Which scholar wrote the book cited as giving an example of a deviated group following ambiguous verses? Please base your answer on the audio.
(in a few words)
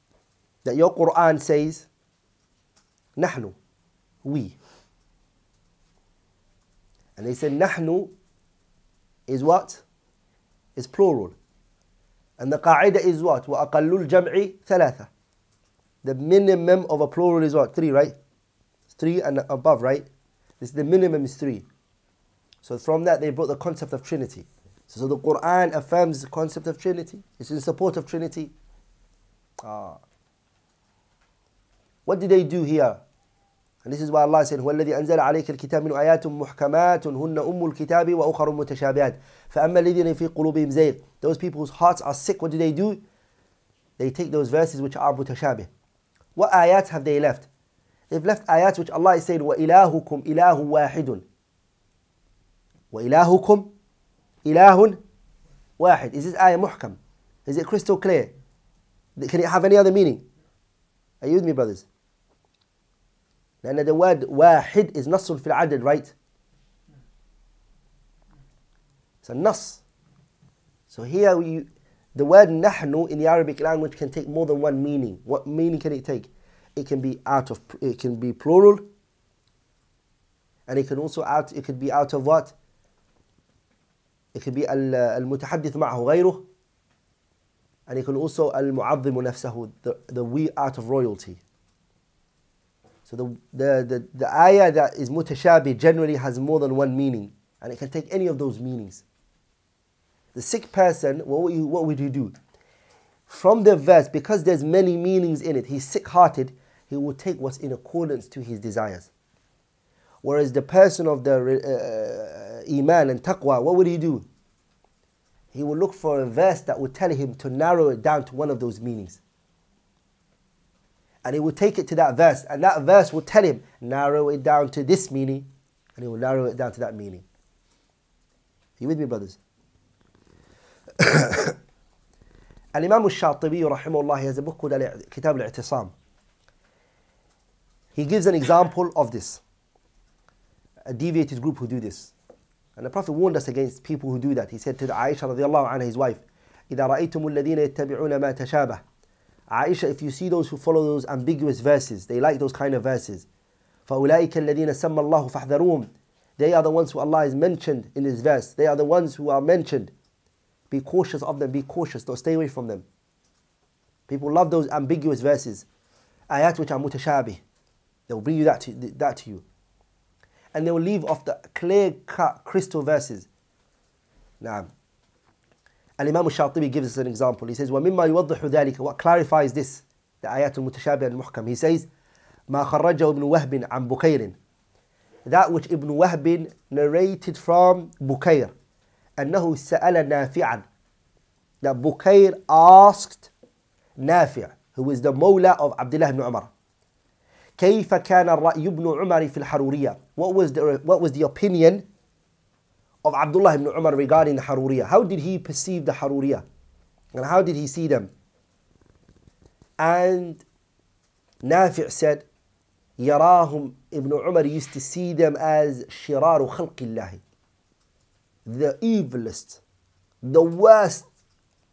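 Imam al-Shatibi.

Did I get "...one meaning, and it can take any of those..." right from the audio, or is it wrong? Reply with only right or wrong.
right.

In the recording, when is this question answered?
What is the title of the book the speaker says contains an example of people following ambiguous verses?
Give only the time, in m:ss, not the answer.
2:15.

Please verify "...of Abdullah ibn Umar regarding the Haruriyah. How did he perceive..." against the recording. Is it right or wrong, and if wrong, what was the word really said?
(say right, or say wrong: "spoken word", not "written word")
right.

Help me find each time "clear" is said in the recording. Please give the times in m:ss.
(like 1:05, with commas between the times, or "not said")
0:57, 2:51.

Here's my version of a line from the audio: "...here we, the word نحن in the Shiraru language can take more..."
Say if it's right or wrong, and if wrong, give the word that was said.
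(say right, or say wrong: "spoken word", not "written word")
wrong: "Arabic", not "Shiraru".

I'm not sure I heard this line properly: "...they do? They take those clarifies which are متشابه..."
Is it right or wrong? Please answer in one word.
wrong.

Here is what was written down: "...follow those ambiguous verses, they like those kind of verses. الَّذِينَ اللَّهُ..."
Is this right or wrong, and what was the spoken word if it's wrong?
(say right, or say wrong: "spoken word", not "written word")
right.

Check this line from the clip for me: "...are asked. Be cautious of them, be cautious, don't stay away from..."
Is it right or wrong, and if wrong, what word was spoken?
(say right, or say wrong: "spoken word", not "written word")
wrong: "mentioned", not "asked".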